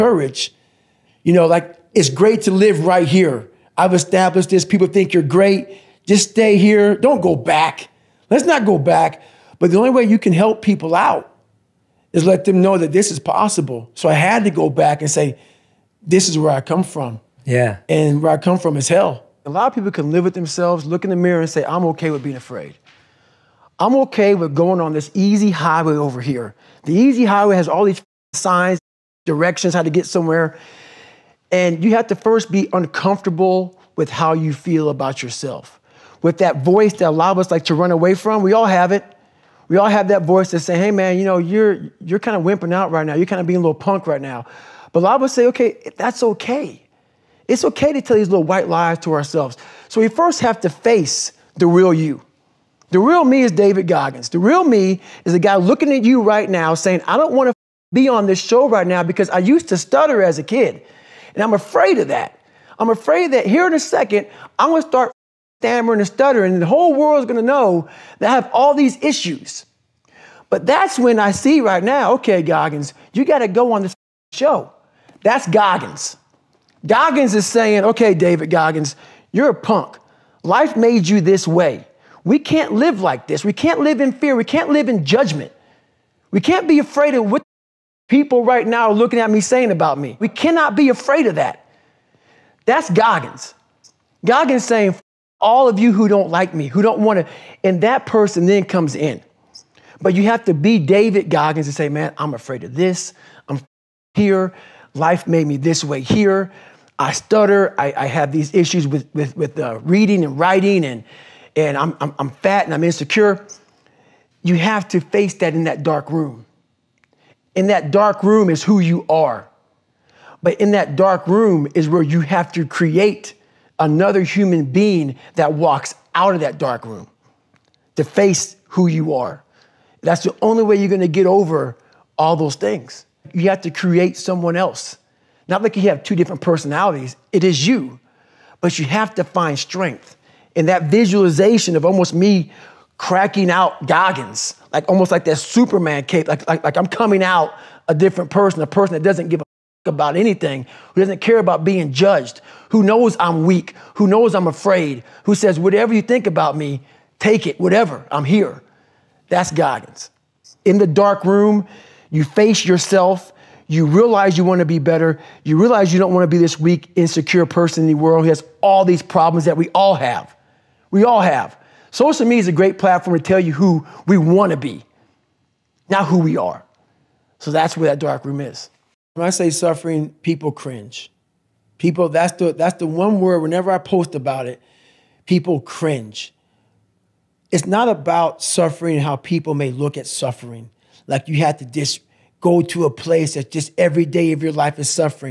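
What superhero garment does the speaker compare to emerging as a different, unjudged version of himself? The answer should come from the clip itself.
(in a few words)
Superman cape.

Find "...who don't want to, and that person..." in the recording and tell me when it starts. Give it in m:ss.
1:36.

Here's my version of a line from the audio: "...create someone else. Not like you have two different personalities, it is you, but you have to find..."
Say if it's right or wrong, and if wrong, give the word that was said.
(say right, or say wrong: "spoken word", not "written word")
right.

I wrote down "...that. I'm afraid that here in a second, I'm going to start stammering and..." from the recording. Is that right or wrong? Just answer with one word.
right.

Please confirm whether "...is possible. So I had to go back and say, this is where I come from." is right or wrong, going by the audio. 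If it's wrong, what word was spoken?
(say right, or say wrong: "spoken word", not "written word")
right.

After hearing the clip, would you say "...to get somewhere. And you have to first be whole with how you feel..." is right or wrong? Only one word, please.
wrong.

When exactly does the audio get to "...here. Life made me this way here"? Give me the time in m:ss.
1:44.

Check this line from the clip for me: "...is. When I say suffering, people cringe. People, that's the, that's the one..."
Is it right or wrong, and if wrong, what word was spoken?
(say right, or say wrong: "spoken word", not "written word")
right.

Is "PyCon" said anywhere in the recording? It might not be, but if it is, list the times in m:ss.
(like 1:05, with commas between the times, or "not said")
not said.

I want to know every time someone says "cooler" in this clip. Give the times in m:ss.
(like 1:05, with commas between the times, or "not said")
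not said.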